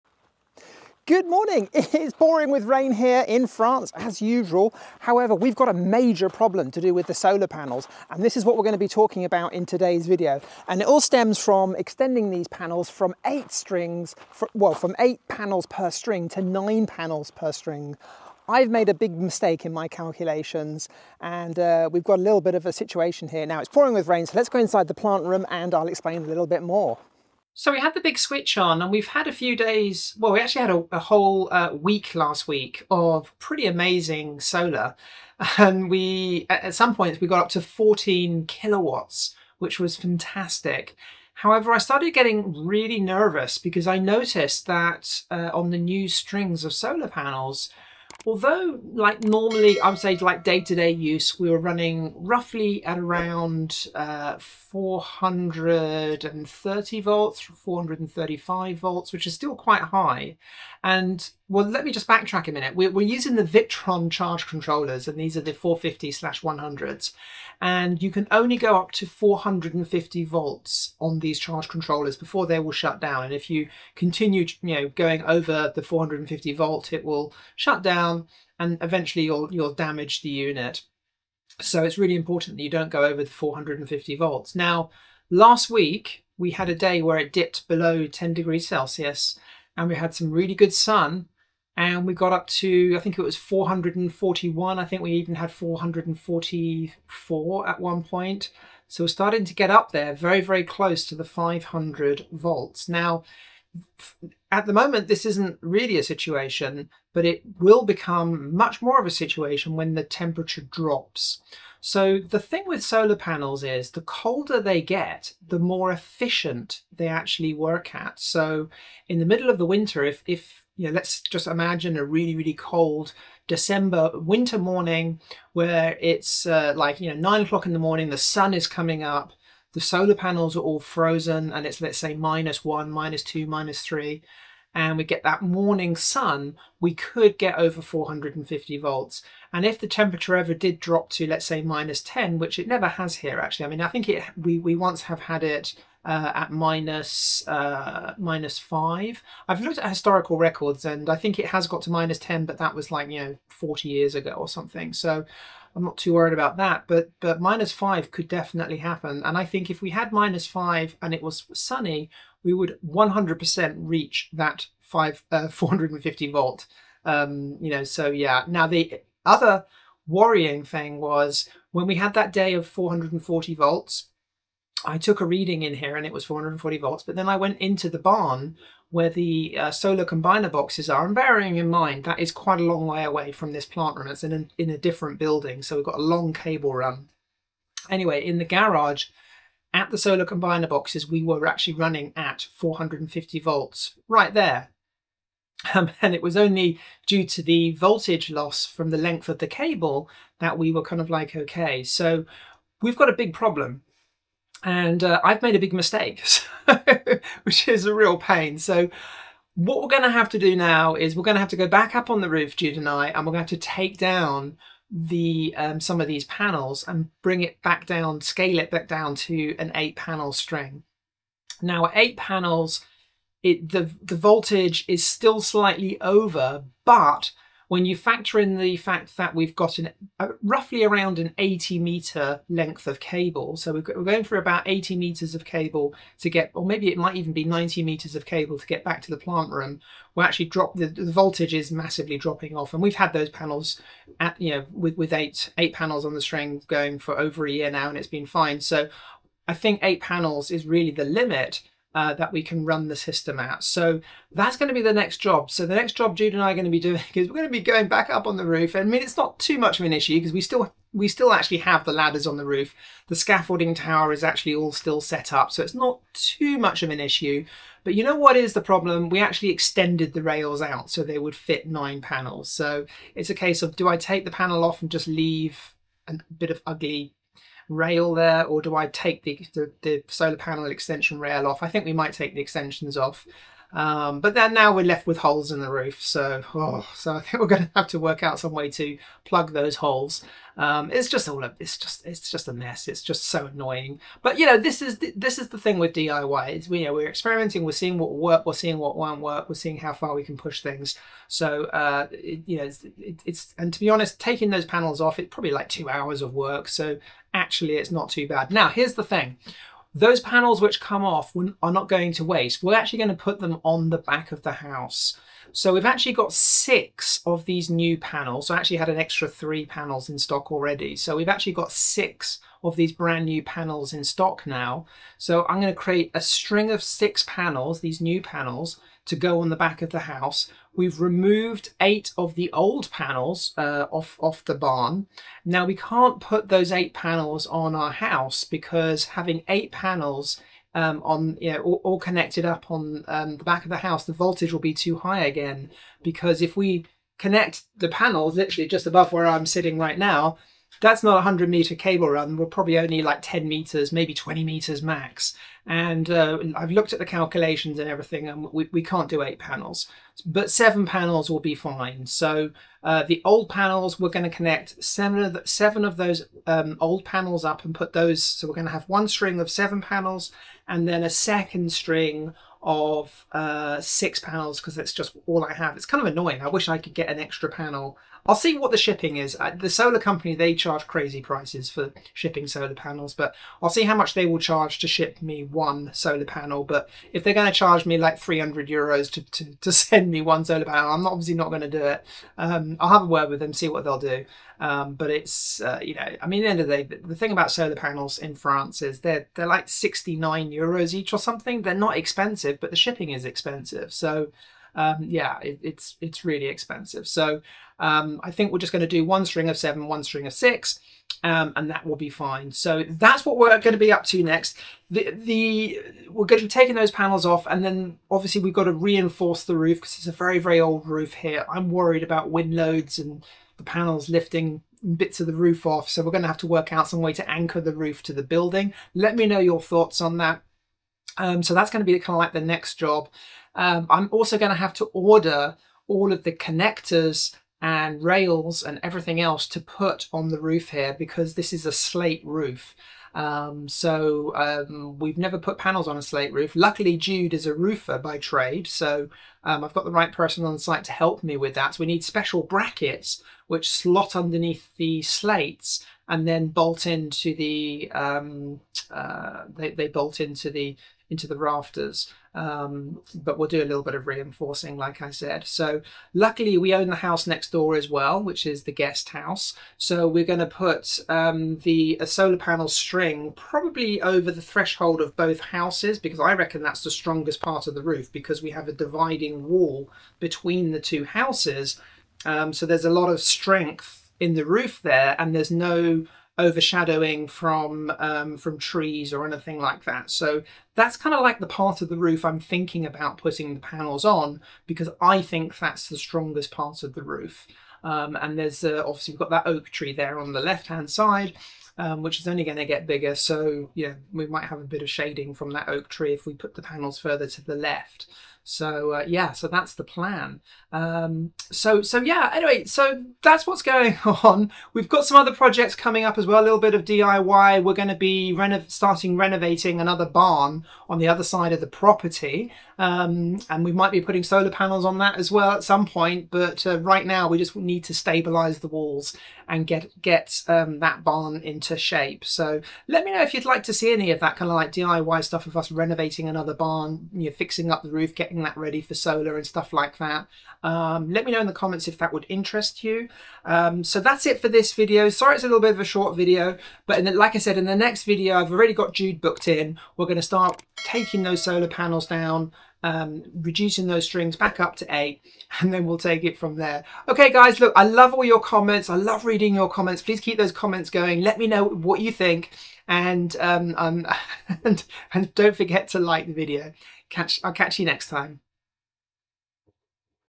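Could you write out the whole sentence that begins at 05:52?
We're probably only like 10 meters, maybe 20 meters max.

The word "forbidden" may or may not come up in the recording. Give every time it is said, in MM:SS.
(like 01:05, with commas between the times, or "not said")
not said.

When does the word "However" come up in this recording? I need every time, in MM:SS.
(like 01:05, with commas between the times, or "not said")
00:05, 00:41.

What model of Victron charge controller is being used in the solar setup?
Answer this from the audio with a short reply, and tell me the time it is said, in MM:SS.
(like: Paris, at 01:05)
450/100, at 01:05.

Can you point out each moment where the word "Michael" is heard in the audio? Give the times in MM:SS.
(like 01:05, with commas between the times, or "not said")
not said.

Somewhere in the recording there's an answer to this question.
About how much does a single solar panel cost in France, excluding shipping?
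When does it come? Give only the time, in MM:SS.
06:39.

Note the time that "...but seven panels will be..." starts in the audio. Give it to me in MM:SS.
06:00.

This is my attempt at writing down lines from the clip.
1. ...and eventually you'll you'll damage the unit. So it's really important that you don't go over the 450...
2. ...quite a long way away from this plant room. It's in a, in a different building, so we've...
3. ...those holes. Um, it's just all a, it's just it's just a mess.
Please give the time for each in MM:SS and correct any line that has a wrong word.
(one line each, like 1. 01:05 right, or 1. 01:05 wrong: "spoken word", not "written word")
1. 01:18 right
2. 03:02 right
3. 04:49 right.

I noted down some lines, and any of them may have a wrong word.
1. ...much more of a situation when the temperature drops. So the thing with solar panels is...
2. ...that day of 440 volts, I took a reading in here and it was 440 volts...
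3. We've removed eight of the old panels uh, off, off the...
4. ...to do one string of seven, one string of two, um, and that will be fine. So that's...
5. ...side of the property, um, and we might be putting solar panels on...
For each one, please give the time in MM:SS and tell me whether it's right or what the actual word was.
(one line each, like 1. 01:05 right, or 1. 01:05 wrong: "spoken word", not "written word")
1. 01:48 right
2. 02:52 right
3. 05:30 right
4. 06:48 wrong: "six", not "two"
5. 08:41 right.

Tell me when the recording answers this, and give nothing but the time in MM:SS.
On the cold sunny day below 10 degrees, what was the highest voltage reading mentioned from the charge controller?
01:35.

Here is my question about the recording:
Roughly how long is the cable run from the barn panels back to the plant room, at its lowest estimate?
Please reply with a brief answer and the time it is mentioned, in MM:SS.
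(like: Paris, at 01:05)
80 meters, at 03:54.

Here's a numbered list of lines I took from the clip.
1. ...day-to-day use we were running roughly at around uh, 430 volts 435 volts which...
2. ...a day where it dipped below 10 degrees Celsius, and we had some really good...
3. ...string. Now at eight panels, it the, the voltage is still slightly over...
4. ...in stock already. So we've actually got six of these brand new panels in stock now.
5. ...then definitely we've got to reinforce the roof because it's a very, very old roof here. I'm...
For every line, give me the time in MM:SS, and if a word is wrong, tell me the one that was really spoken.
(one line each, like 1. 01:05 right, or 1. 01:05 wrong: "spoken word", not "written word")
1. 00:50 right
2. 01:26 right
3. 03:40 right
4. 05:20 right
5. 06:57 wrong: "obviously", not "definitely".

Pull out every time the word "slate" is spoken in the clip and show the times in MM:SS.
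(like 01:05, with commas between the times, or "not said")
07:21, 07:26, 07:35.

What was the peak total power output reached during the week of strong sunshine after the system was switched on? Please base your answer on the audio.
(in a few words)
14 kilowatts.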